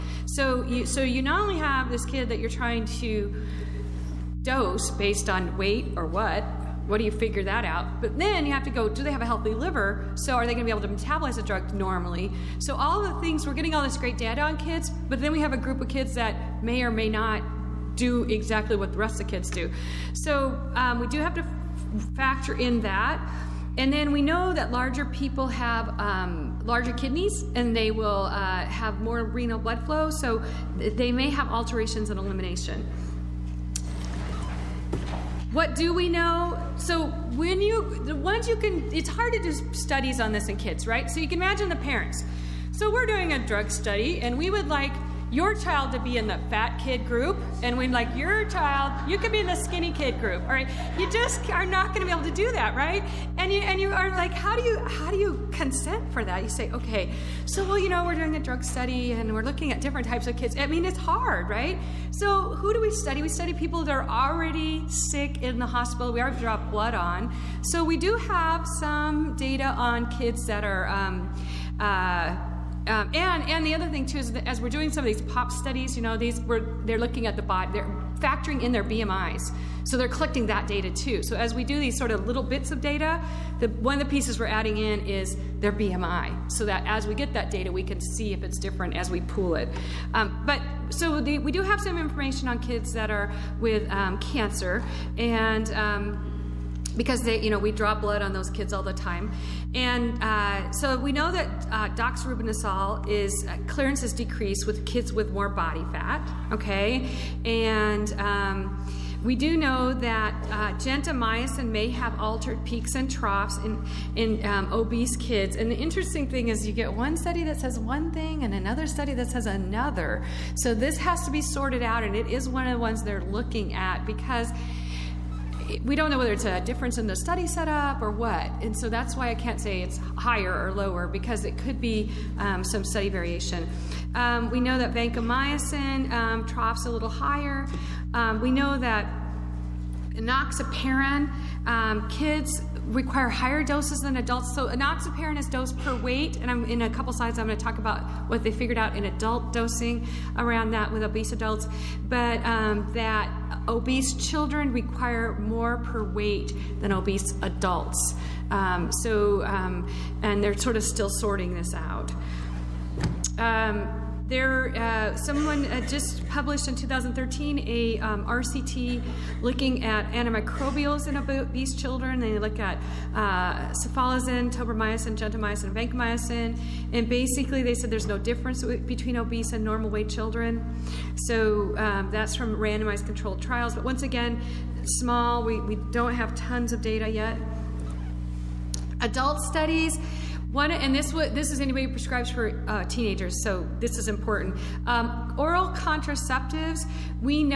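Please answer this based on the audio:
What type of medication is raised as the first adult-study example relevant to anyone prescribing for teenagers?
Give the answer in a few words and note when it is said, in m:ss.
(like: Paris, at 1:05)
oral contraceptives, at 3:15.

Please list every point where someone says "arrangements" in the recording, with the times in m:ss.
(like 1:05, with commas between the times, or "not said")
not said.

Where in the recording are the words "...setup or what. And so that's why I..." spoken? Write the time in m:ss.
2:07.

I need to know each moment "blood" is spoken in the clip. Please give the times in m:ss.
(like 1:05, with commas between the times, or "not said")
0:29, 1:06, 1:37.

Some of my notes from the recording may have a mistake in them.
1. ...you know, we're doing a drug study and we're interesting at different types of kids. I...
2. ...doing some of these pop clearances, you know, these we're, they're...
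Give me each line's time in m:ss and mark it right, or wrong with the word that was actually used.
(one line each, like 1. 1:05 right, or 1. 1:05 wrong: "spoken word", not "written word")
1. 0:57 wrong: "looking", not "interesting"
2. 1:14 wrong: "studies", not "clearances".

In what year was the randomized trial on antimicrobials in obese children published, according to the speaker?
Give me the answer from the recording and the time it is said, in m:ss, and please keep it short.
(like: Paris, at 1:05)
2013, at 2:46.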